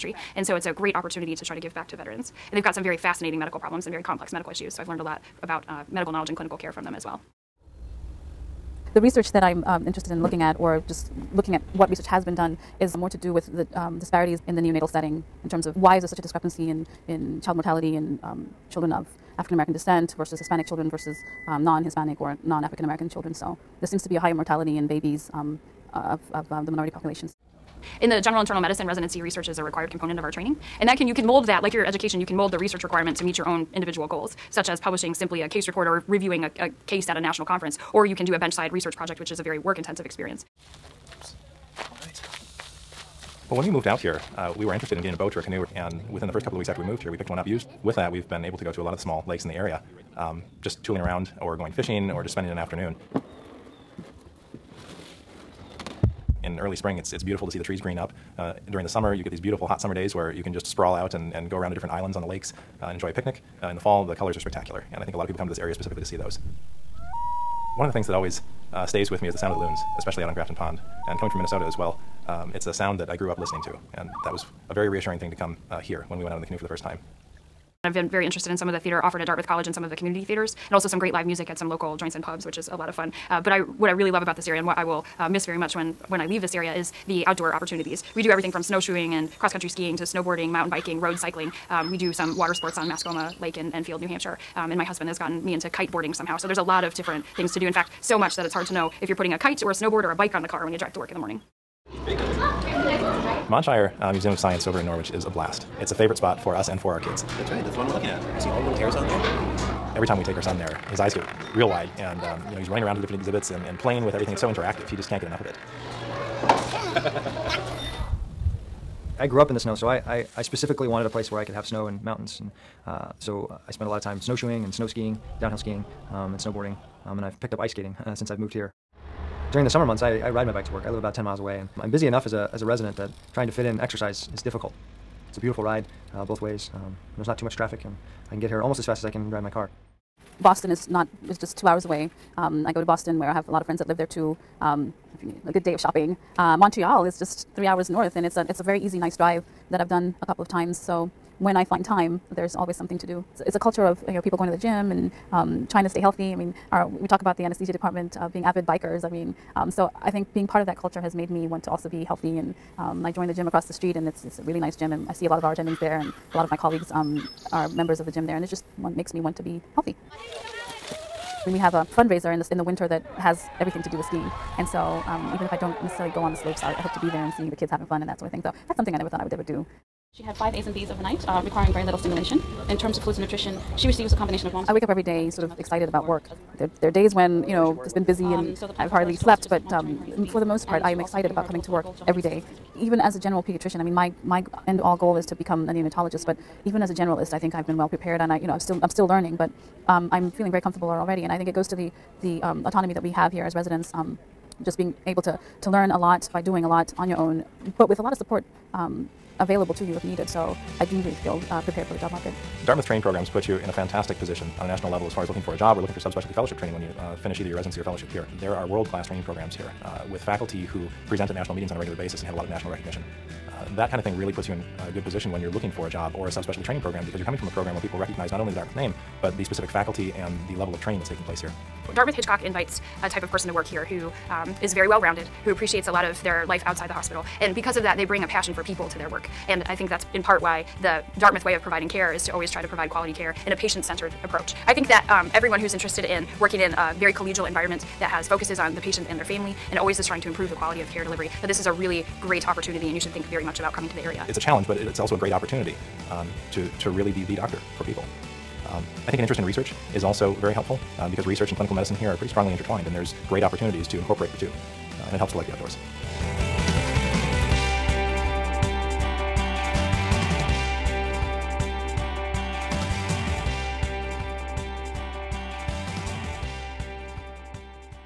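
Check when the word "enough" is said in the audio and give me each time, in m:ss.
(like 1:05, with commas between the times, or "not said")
1:55, 2:12.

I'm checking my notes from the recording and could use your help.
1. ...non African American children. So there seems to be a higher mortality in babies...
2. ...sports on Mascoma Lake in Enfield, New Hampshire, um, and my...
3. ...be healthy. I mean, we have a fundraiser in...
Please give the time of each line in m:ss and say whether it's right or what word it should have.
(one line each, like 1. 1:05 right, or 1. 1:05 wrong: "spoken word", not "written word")
1. 0:22 right
2. 1:32 right
3. 2:49 right.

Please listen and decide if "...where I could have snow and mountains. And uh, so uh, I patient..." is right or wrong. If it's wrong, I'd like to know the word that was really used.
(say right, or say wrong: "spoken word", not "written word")
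wrong: "spent", not "patient".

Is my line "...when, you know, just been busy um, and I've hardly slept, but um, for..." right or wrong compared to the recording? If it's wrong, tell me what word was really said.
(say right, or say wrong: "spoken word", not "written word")
right.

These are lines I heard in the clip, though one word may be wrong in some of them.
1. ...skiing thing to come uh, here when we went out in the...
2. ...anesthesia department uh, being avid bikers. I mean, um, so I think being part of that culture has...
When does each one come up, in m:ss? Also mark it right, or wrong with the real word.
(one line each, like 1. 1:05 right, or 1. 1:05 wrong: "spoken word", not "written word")
1. 1:14 wrong: "reassuring", not "skiing"
2. 2:37 right.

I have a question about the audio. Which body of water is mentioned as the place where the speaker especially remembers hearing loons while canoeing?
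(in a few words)
Grafton Pond.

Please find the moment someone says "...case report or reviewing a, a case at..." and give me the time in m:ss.
0:35.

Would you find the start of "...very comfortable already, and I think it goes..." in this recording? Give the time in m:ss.
3:20.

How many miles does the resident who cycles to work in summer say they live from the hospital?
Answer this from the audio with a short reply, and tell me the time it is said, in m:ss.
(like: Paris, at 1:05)
10, at 2:11.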